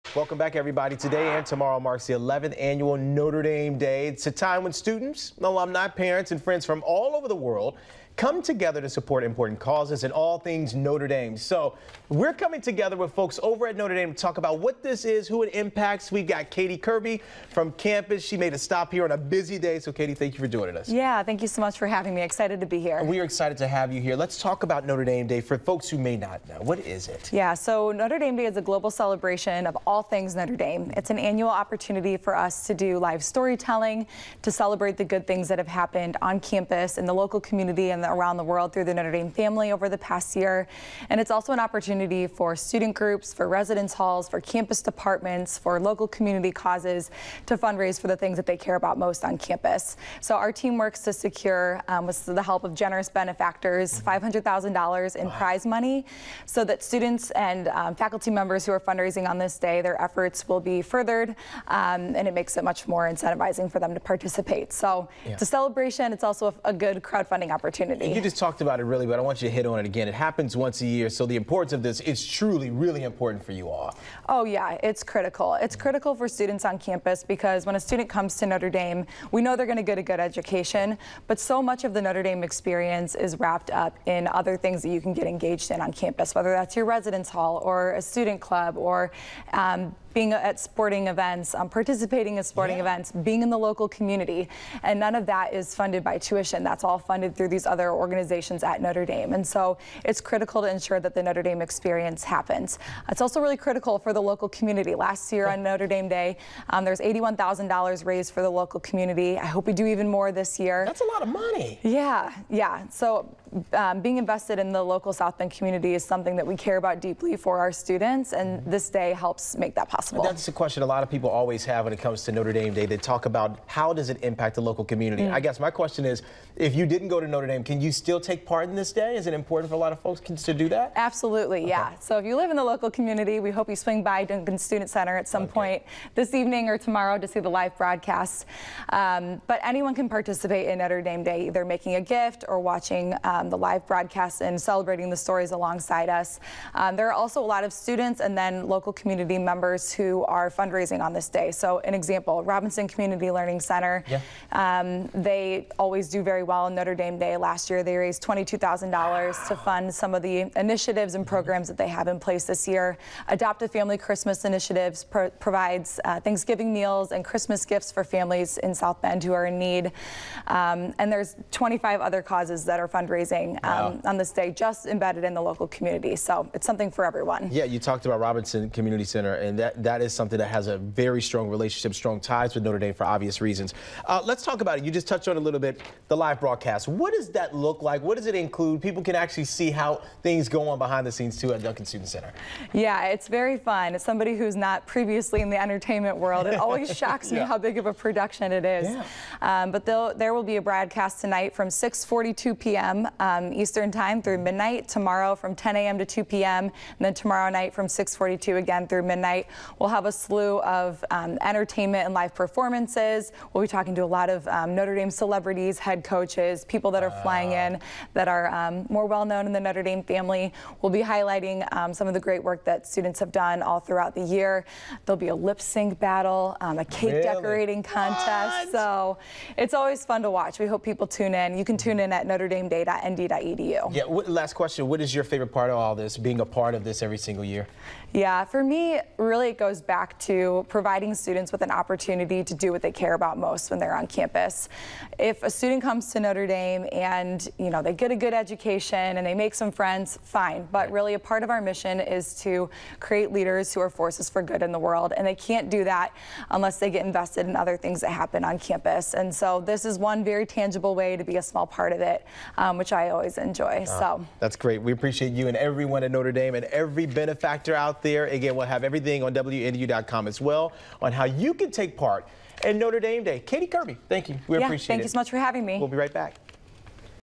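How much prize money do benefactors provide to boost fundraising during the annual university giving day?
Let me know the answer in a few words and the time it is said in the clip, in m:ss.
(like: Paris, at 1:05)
$500,000, at 0:54.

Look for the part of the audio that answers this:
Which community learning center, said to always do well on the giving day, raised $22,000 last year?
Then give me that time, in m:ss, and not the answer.
2:32.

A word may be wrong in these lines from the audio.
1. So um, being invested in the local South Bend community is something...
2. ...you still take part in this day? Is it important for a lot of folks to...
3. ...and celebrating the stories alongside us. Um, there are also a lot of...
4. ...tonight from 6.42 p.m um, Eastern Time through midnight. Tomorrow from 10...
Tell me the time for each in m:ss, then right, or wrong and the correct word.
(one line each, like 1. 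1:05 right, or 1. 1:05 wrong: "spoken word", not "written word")
1. 1:52 right
2. 2:07 right
3. 2:24 right
4. 3:21 right.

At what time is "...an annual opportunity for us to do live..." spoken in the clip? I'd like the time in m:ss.
0:31.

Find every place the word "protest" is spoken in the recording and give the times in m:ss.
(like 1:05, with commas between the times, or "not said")
not said.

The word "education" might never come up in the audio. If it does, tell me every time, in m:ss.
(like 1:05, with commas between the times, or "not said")
1:20, 4:08.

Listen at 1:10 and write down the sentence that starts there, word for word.
It happens once a year, so the importance of this is truly, really important for you all.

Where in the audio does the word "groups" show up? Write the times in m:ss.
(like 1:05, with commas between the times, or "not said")
0:42.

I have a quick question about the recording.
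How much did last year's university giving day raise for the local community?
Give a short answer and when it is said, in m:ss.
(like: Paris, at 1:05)
$81,000, at 1:46.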